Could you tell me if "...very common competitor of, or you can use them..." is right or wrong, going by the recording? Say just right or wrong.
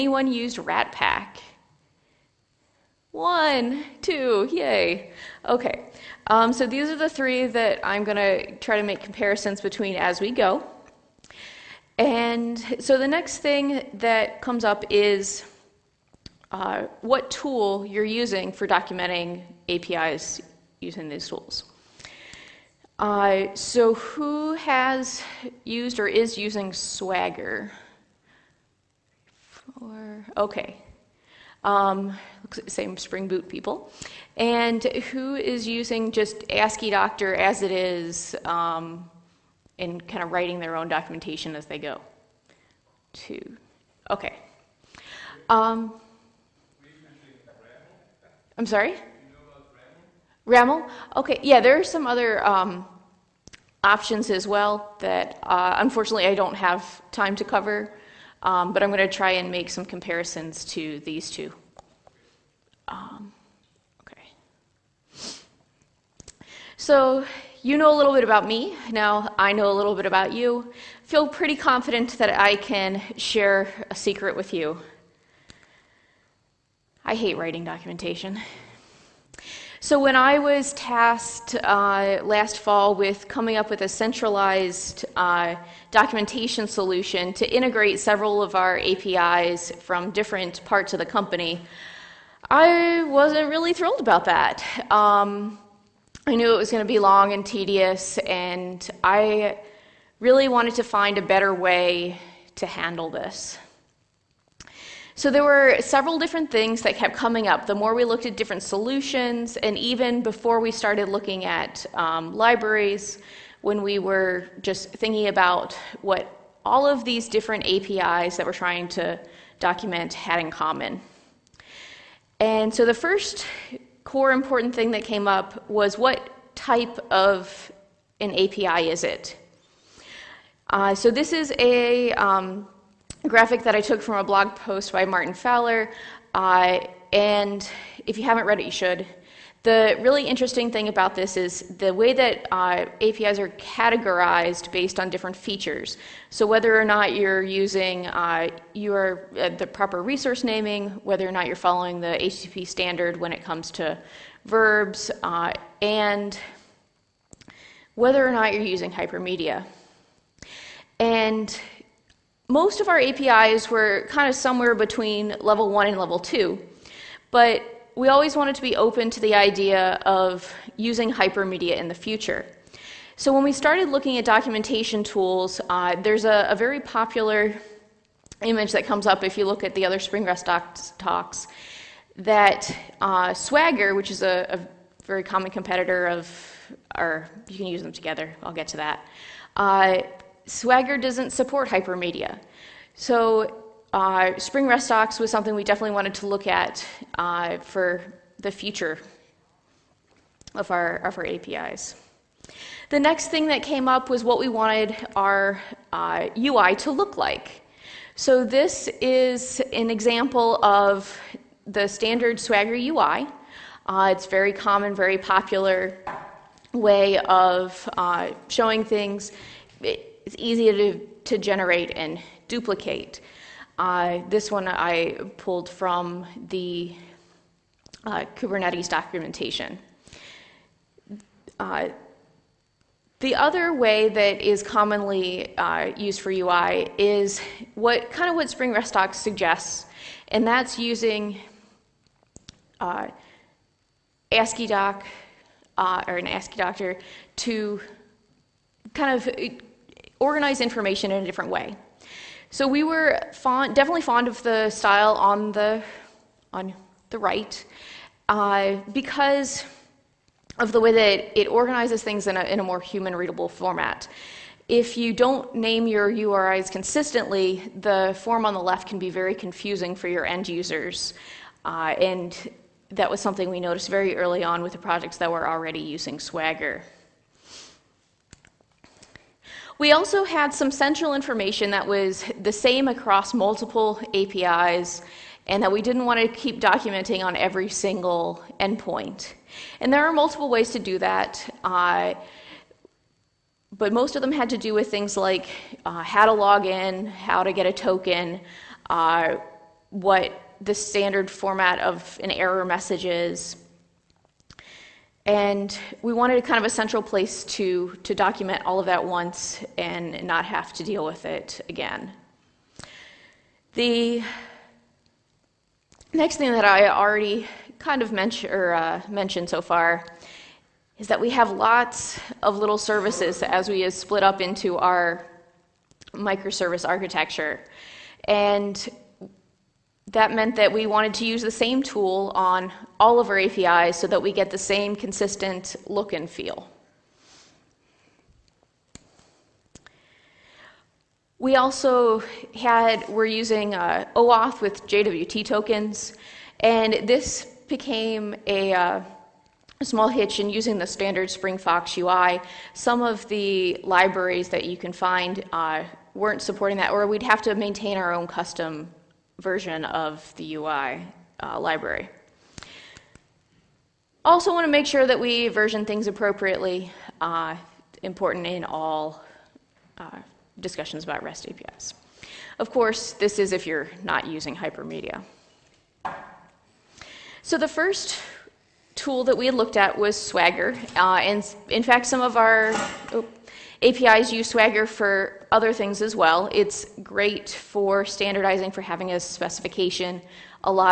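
right.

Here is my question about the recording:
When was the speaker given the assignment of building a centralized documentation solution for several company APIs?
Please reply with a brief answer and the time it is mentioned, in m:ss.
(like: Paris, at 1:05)
last fall, at 1:22.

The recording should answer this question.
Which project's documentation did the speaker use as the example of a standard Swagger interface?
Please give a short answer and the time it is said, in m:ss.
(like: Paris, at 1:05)
Kubernetes, at 3:48.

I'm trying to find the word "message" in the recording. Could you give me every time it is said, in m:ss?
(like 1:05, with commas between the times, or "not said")
5:02.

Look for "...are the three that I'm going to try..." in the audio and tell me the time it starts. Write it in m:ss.
0:06.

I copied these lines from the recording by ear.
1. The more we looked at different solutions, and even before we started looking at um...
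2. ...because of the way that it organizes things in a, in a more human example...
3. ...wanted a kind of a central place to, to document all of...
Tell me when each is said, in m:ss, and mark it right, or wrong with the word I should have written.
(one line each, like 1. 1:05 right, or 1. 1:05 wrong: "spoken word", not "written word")
1. 1:47 right
2. 4:18 wrong: "readable", not "example"
3. 5:06 right.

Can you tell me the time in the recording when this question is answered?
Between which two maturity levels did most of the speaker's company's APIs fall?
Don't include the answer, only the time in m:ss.
2:45.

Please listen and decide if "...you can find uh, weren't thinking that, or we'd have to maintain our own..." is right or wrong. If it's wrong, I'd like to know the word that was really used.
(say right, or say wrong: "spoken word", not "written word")
wrong: "supporting", not "thinking".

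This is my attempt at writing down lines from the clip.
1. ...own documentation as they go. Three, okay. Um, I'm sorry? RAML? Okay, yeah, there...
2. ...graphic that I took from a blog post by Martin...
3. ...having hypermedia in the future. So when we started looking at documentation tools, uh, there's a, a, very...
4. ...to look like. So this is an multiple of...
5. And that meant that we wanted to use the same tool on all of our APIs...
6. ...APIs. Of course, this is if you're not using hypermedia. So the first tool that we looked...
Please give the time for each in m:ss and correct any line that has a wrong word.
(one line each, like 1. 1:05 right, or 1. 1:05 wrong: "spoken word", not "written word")
1. 0:40 wrong: "Two", not "Three"
2. 2:13 right
3. 2:50 wrong: "using", not "having"
4. 3:26 wrong: "example", not "multiple"
5. 5:28 right
6. 6:11 right.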